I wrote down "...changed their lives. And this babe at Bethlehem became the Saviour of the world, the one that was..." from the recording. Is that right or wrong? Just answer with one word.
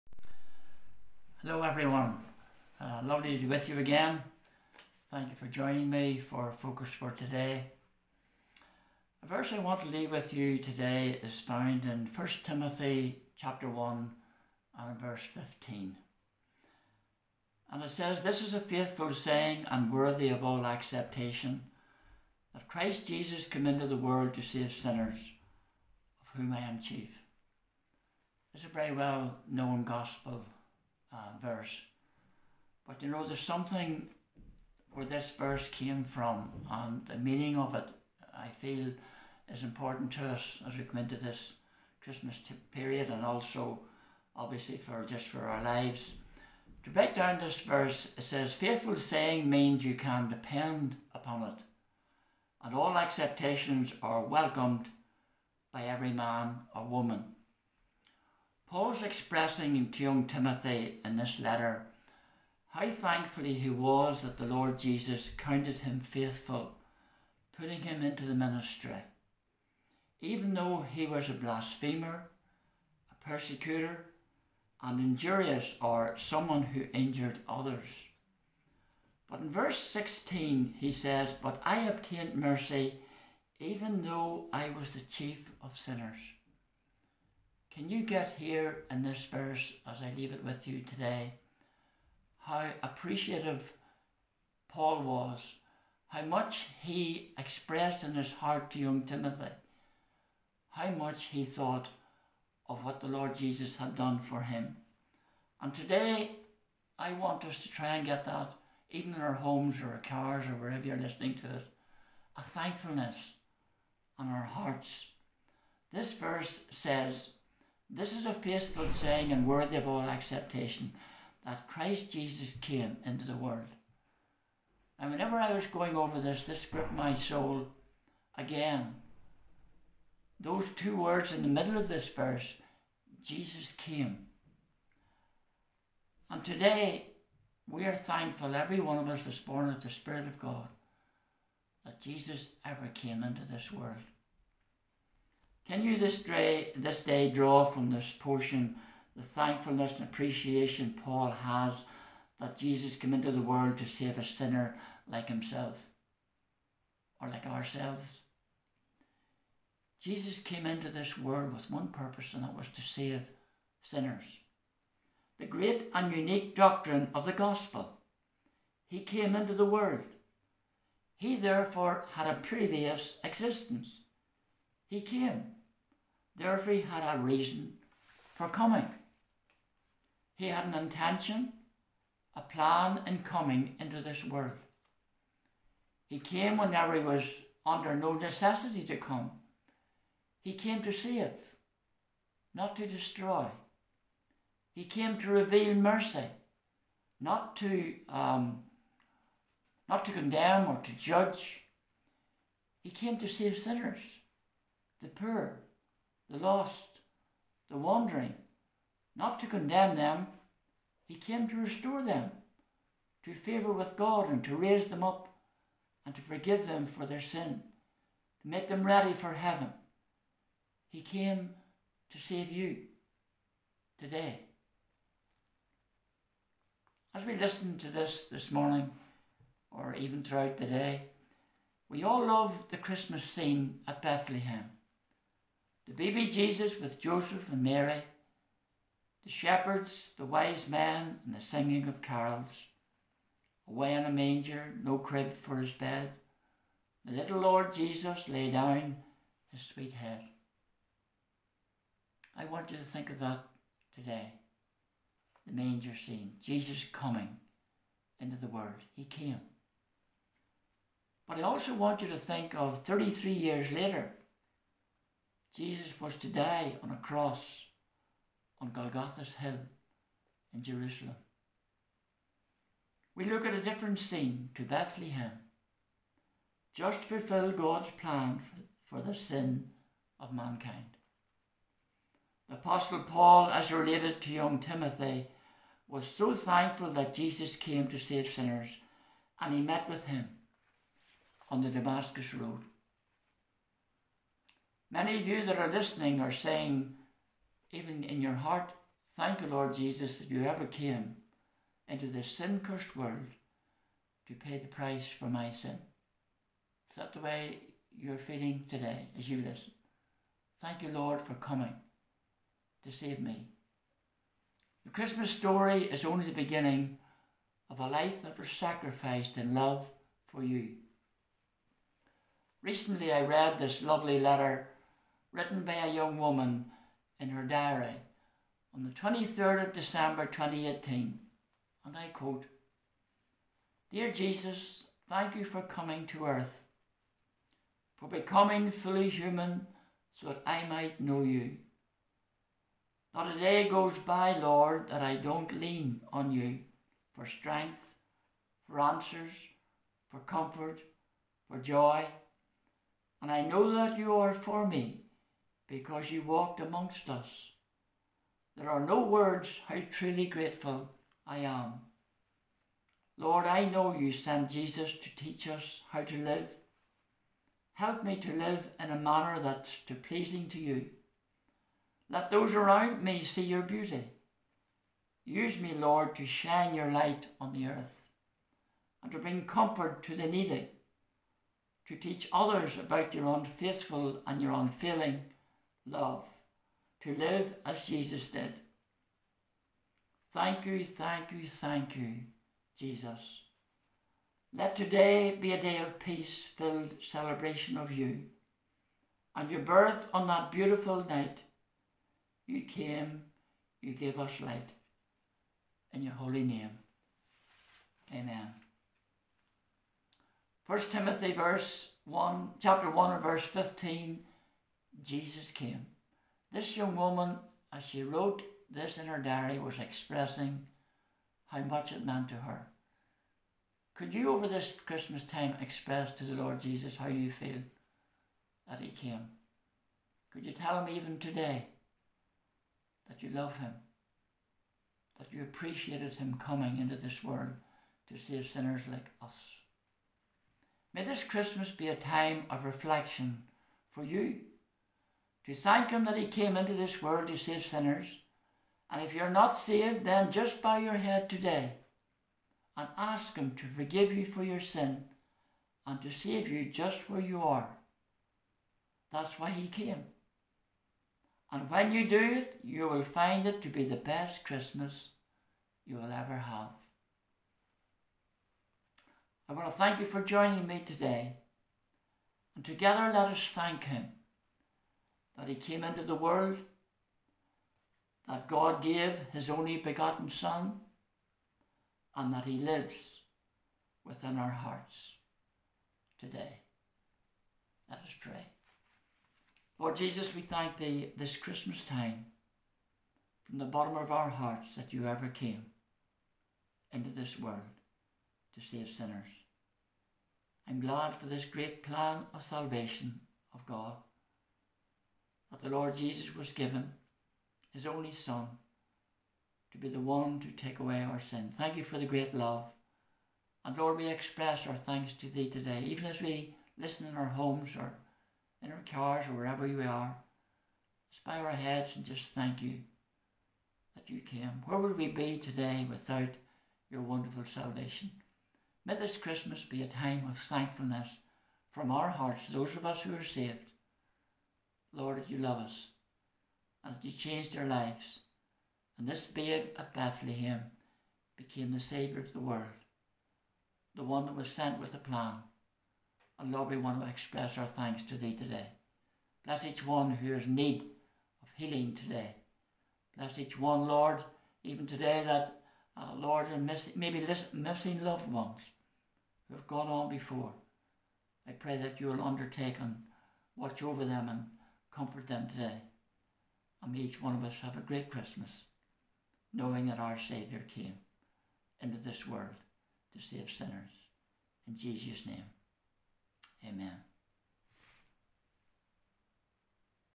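right.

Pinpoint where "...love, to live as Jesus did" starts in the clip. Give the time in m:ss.
6:25.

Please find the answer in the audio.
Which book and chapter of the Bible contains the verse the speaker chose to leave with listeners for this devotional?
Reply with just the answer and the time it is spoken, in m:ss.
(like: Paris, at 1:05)
1 Timothy chapter 1, at 0:12.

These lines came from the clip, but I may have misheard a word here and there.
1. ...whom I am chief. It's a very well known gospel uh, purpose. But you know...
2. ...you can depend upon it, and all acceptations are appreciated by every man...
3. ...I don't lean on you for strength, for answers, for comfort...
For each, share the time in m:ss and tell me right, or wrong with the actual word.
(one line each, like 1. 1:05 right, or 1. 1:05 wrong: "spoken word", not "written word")
1. 0:26 wrong: "verse", not "purpose"
2. 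0:49 wrong: "welcomed", not "appreciated"
3. 5:45 right.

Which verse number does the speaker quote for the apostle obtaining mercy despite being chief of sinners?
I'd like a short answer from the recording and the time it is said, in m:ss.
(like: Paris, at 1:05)
16, at 1:19.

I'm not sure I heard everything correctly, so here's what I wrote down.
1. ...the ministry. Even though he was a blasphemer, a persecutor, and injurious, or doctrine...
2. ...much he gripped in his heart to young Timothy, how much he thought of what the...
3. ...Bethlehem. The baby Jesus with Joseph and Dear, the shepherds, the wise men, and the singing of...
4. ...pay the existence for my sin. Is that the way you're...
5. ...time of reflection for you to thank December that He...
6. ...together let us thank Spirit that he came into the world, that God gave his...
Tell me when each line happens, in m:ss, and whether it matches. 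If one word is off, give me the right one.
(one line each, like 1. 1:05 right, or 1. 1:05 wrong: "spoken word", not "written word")
1. 1:08 wrong: "someone", not "doctrine"
2. 1:36 wrong: "expressed", not "gripped"
3. 3:54 wrong: "Mary", not "Dear"
4. 5:04 wrong: "price", not "existence"
5. 7:21 wrong: "Him", not "December"
6. 7:52 wrong: "Him", not "Spirit".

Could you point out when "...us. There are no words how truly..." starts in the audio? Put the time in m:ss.
5:57.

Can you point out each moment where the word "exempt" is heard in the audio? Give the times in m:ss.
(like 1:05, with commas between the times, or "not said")
not said.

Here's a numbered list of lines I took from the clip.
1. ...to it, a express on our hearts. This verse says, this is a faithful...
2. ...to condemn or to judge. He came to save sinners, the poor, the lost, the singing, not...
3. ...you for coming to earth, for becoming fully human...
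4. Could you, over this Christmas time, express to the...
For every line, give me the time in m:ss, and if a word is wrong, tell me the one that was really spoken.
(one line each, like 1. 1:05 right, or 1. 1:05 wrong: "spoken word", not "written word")
1. 1:51 wrong: "thankfulness", not "express"
2. 3:20 wrong: "wandering", not "singing"
3. 5:35 right
4. 7:03 right.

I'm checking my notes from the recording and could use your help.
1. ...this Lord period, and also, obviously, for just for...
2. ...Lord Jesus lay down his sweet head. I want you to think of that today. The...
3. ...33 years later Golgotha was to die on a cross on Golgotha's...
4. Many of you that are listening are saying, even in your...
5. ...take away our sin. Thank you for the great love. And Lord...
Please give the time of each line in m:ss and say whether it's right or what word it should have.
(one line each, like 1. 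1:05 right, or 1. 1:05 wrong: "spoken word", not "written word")
1. 0:41 wrong: "Christmas", not "Lord"
2. 4:07 right
3. 4:22 wrong: "Jesus", not "Golgotha"
4. 4:54 right
5. 8:30 right.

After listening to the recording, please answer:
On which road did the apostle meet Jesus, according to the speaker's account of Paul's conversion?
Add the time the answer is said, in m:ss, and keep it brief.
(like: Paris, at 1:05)
Damascus Road, at 4:51.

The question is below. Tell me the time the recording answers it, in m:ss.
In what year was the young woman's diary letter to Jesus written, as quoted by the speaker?
5:30.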